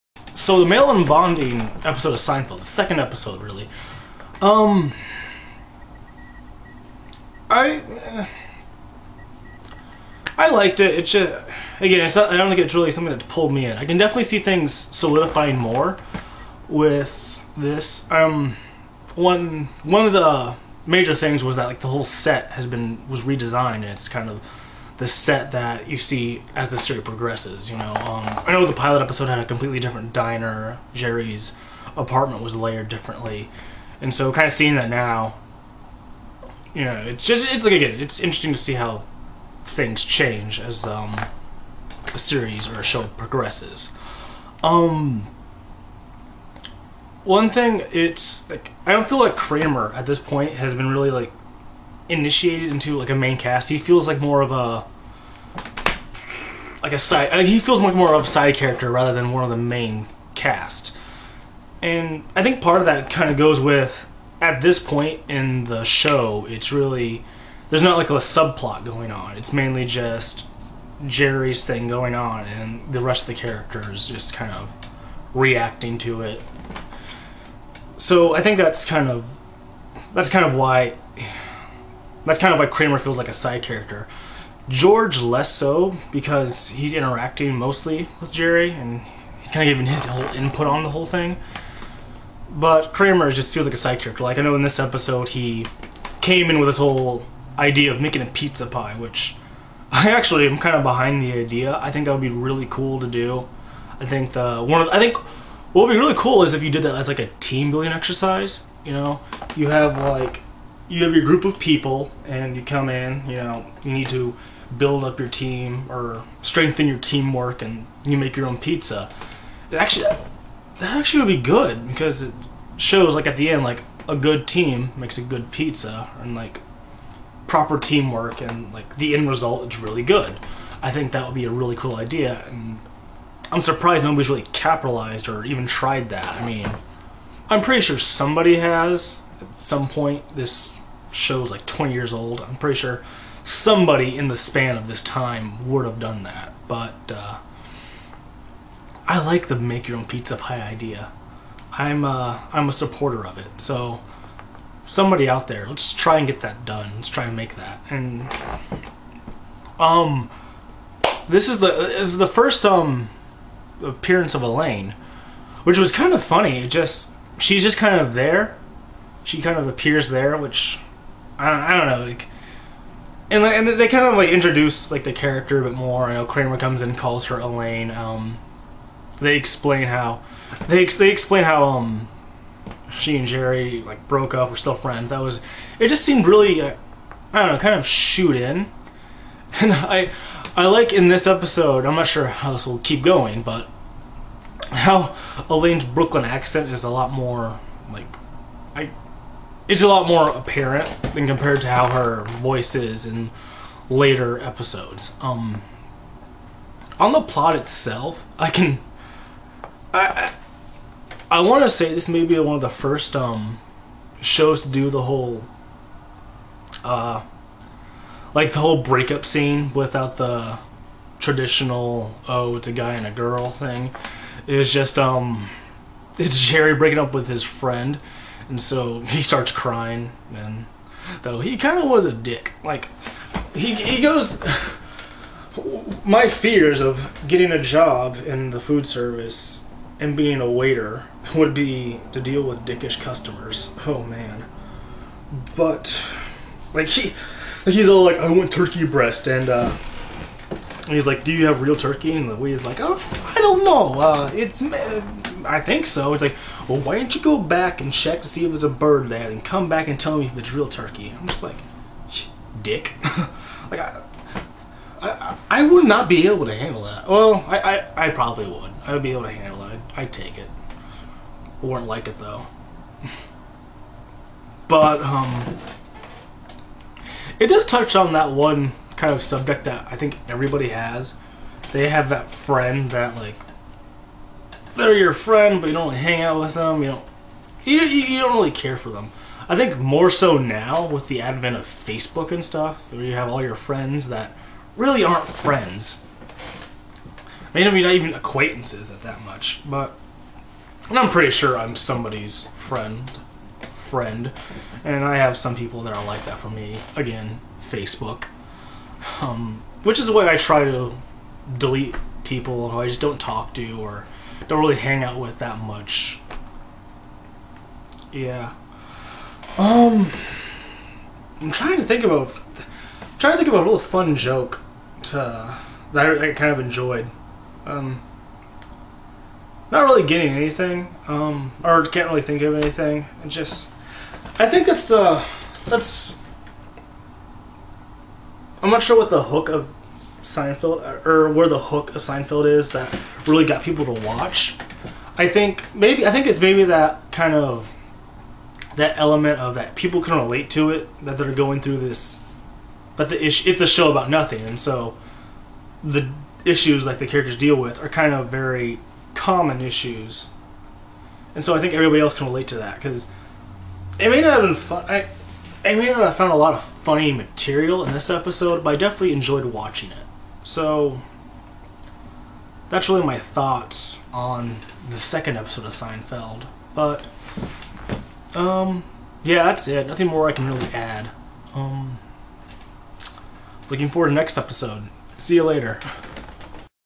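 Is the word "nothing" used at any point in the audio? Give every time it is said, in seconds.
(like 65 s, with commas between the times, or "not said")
354 s, 379 s.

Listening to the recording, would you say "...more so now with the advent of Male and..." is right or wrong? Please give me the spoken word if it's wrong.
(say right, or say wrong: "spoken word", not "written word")
wrong: "Facebook", not "Male".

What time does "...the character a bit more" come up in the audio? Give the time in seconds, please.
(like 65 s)
175 s.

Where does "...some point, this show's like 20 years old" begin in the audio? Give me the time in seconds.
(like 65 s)
139 s.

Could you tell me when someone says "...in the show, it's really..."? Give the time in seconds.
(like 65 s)
65 s.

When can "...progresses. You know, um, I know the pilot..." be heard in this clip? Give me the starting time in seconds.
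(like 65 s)
27 s.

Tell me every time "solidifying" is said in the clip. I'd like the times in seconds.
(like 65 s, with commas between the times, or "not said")
14 s.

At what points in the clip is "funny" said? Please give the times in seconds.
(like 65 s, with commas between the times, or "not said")
166 s, 366 s.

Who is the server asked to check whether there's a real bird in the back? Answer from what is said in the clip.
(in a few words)
Louis.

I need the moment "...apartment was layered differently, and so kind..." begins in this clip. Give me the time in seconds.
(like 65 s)
31 s.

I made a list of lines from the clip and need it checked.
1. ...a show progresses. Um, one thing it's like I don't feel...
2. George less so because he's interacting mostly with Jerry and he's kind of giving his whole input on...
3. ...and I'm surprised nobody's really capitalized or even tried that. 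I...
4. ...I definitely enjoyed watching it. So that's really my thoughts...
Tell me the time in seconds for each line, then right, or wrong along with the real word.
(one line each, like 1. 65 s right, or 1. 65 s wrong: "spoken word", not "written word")
1. 42 s right
2. 84 s right
3. 132 s right
4. 368 s right.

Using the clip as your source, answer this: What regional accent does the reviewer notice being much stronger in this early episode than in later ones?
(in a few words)
Brooklyn.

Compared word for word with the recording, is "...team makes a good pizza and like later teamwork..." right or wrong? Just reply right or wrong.
wrong.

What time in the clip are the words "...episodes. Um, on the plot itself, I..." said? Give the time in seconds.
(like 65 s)
204 s.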